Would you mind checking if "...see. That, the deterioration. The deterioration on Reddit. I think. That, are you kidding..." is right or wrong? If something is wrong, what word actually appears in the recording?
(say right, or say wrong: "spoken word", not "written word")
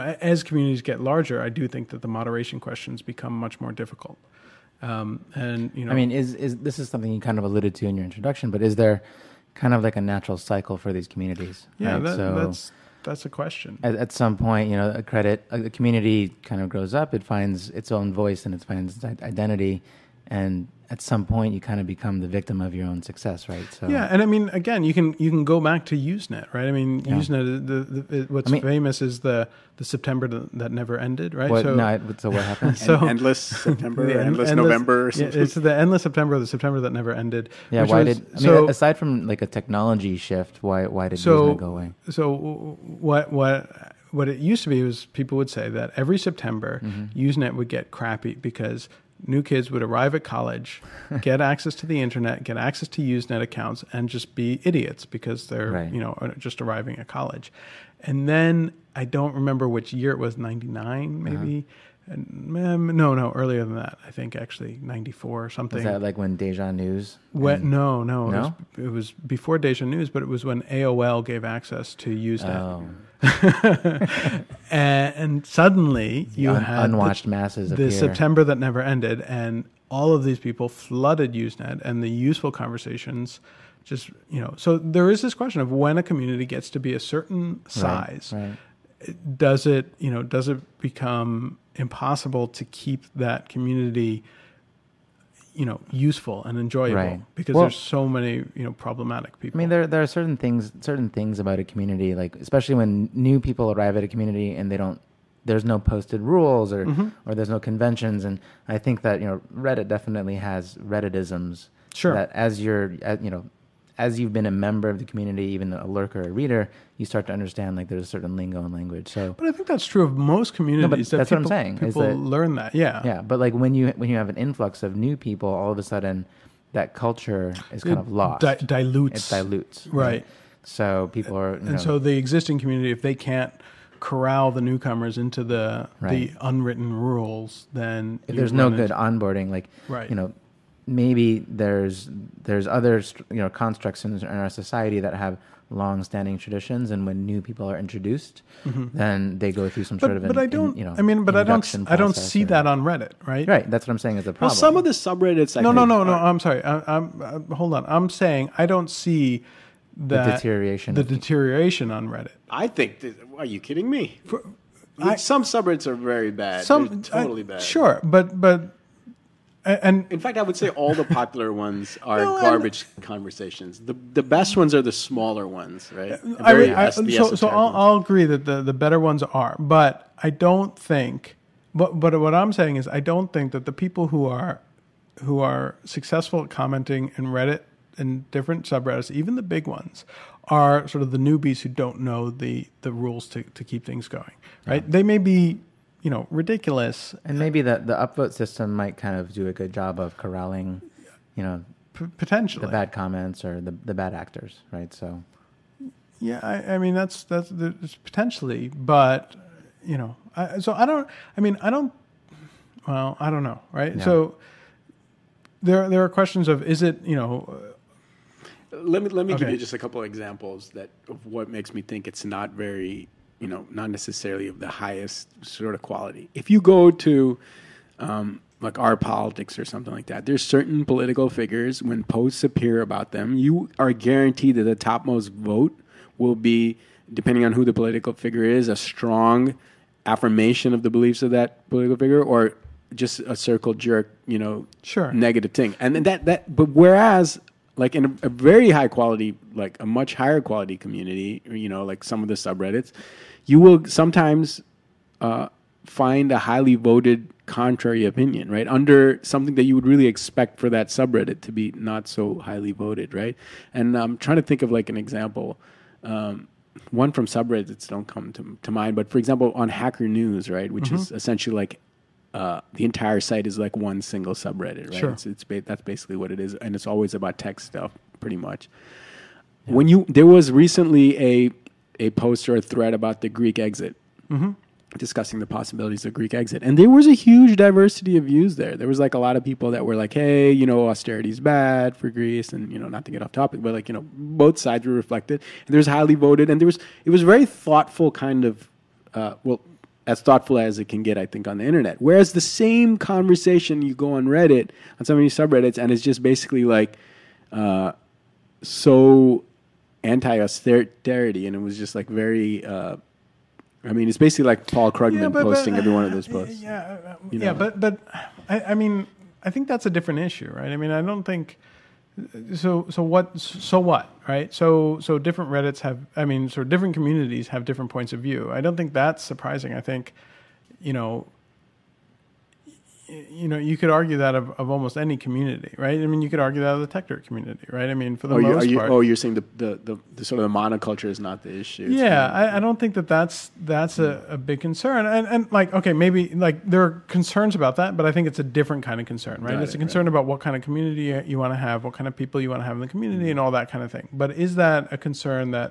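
right.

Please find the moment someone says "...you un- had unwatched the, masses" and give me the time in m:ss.
1:16.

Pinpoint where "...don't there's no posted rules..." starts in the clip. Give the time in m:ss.
1:44.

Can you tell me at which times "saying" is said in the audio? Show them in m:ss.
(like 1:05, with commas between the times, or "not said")
2:01, 2:33, 2:38, 3:02, 5:39.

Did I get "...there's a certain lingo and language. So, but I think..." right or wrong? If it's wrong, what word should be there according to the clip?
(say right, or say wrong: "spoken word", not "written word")
right.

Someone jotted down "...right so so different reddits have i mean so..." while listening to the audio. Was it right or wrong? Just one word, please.
right.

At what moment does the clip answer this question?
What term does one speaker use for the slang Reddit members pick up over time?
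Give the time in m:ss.
1:50.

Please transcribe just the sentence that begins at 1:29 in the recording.
does it you know does it become impossible to keep that community?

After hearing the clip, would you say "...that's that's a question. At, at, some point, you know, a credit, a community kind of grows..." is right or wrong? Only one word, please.
right.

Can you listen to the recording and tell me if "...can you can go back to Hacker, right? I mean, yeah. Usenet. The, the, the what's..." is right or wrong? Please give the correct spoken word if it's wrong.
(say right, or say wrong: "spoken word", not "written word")
wrong: "Usenet", not "Hacker".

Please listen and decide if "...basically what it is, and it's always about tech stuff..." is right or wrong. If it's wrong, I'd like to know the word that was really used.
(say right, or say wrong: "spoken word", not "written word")
right.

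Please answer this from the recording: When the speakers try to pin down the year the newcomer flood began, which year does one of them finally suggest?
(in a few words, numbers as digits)
1994.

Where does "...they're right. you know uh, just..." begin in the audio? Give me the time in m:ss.
0:55.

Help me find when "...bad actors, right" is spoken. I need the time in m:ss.
3:23.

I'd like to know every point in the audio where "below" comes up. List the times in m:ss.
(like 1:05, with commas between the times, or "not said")
not said.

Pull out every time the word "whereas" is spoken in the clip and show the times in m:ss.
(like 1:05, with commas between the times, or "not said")
4:06, 5:01.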